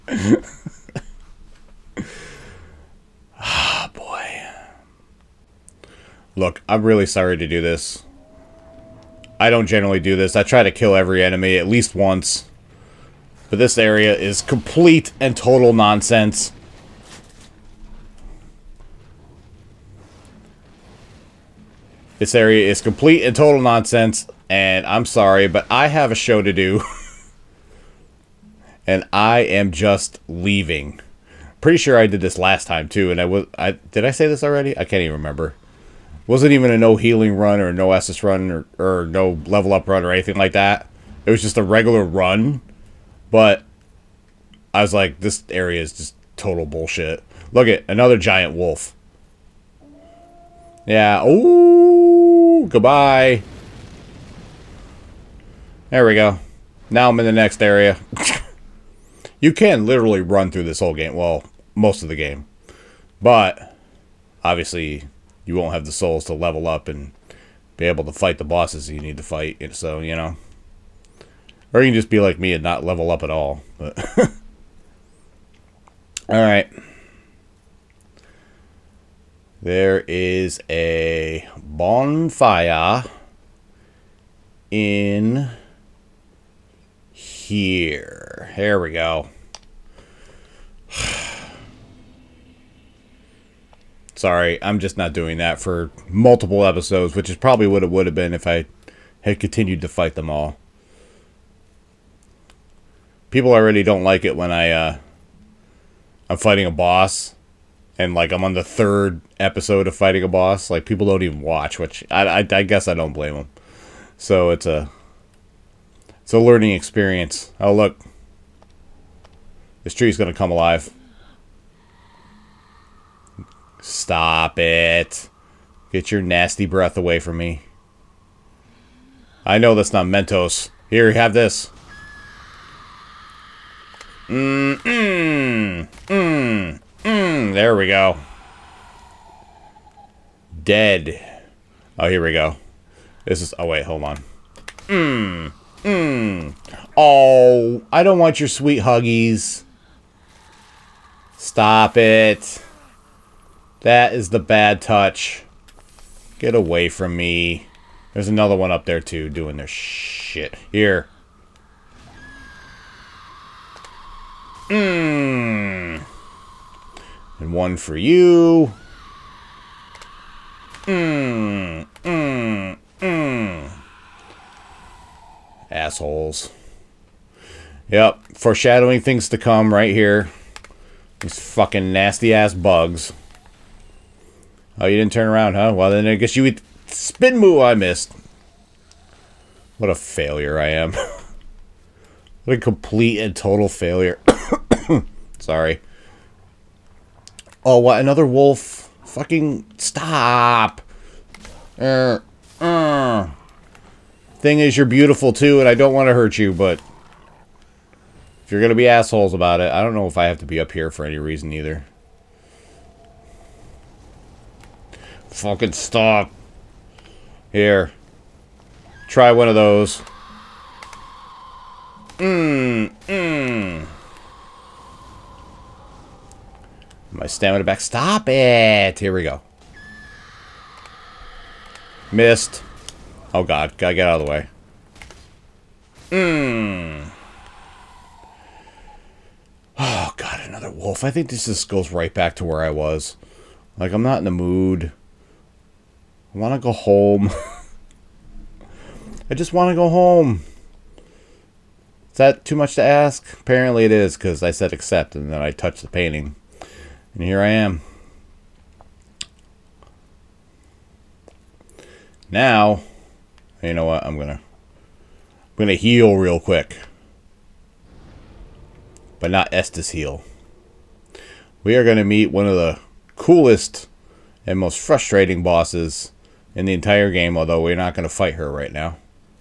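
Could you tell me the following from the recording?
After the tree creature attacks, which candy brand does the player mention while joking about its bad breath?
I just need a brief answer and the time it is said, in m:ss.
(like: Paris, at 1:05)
Mentos, at 2:10.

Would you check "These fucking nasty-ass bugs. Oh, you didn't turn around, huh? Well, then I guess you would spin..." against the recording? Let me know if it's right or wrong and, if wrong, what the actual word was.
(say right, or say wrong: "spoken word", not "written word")
right.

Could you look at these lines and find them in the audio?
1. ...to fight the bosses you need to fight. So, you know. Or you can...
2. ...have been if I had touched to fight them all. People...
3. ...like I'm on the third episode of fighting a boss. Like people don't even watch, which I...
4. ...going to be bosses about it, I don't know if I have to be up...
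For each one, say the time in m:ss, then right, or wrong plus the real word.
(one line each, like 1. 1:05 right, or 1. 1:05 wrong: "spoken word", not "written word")
1. 1:08 right
2. 1:38 wrong: "continued", not "touched"
3. 1:48 right
4. 3:28 wrong: "assholes", not "bosses".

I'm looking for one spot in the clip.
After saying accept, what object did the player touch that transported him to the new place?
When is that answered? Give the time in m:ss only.
4:15.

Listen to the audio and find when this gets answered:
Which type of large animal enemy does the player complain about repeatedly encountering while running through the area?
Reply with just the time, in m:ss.
0:48.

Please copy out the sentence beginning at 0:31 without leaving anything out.
Pretty sure I did this last time too, and I was I did I say this already?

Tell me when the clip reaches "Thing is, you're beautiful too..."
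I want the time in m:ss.
3:24.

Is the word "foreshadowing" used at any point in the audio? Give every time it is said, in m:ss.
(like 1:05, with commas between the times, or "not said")
2:58.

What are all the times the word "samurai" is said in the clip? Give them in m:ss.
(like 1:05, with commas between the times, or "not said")
not said.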